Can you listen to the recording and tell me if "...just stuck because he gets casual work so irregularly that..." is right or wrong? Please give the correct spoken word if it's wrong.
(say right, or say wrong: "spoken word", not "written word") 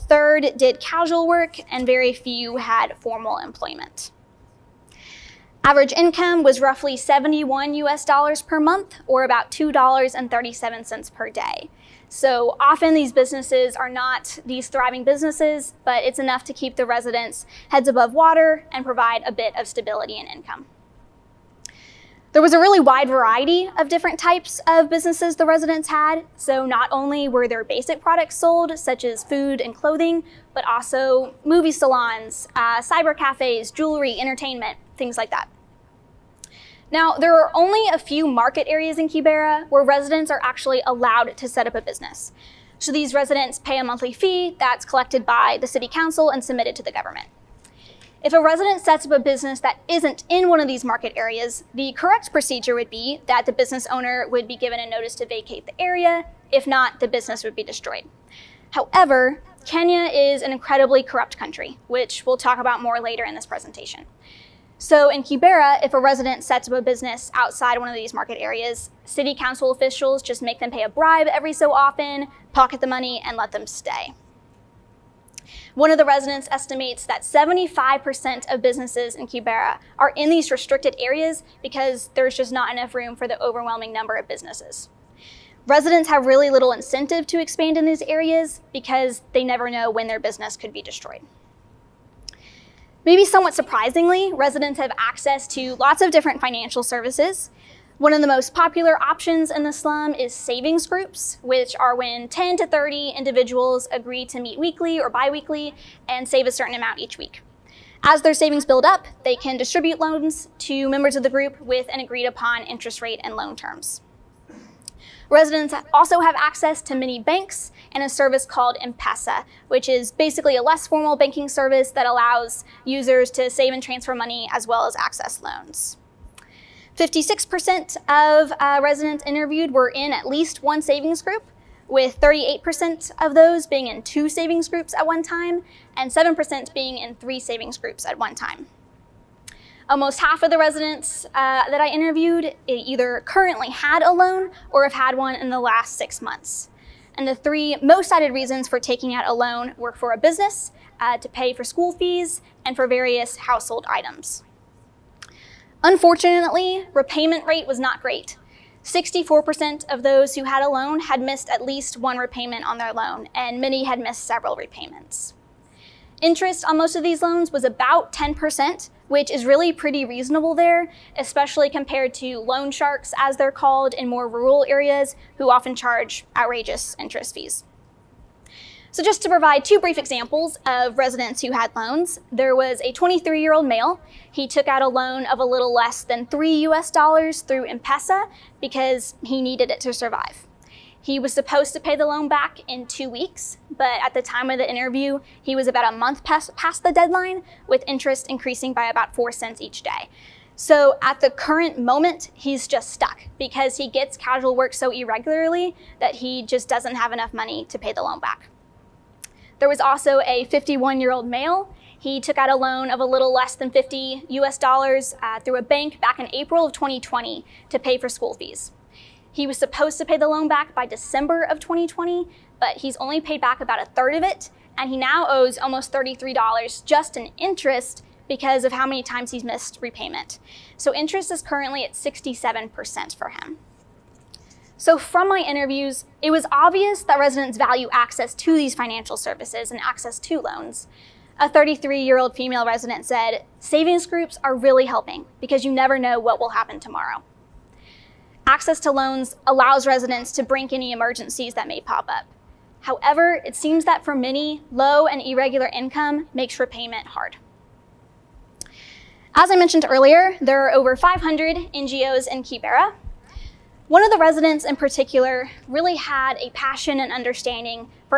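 right.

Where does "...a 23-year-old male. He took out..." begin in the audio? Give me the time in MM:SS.
03:02.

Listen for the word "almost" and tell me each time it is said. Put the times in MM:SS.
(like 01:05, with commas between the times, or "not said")
02:19, 03:45.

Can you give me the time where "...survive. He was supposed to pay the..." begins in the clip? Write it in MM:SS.
03:09.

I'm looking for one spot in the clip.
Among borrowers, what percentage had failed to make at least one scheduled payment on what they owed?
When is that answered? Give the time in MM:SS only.
02:38.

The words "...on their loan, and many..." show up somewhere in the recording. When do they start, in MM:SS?
02:42.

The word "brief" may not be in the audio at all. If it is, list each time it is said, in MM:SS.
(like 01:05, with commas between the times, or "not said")
02:59.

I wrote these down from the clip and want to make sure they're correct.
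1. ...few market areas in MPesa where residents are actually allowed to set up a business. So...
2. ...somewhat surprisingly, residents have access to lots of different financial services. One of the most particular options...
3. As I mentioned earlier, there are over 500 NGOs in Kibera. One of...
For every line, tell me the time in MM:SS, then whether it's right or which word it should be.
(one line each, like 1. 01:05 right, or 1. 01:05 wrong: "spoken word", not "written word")
1. 00:37 wrong: "Kibera", not "MPesa"
2. 01:33 wrong: "popular", not "particular"
3. 04:19 right.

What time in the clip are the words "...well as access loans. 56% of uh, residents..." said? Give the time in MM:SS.
02:04.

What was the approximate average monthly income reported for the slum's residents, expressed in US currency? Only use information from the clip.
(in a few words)
$71.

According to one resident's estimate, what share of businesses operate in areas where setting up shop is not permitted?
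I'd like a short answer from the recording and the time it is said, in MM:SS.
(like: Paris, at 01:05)
75%, at 01:17.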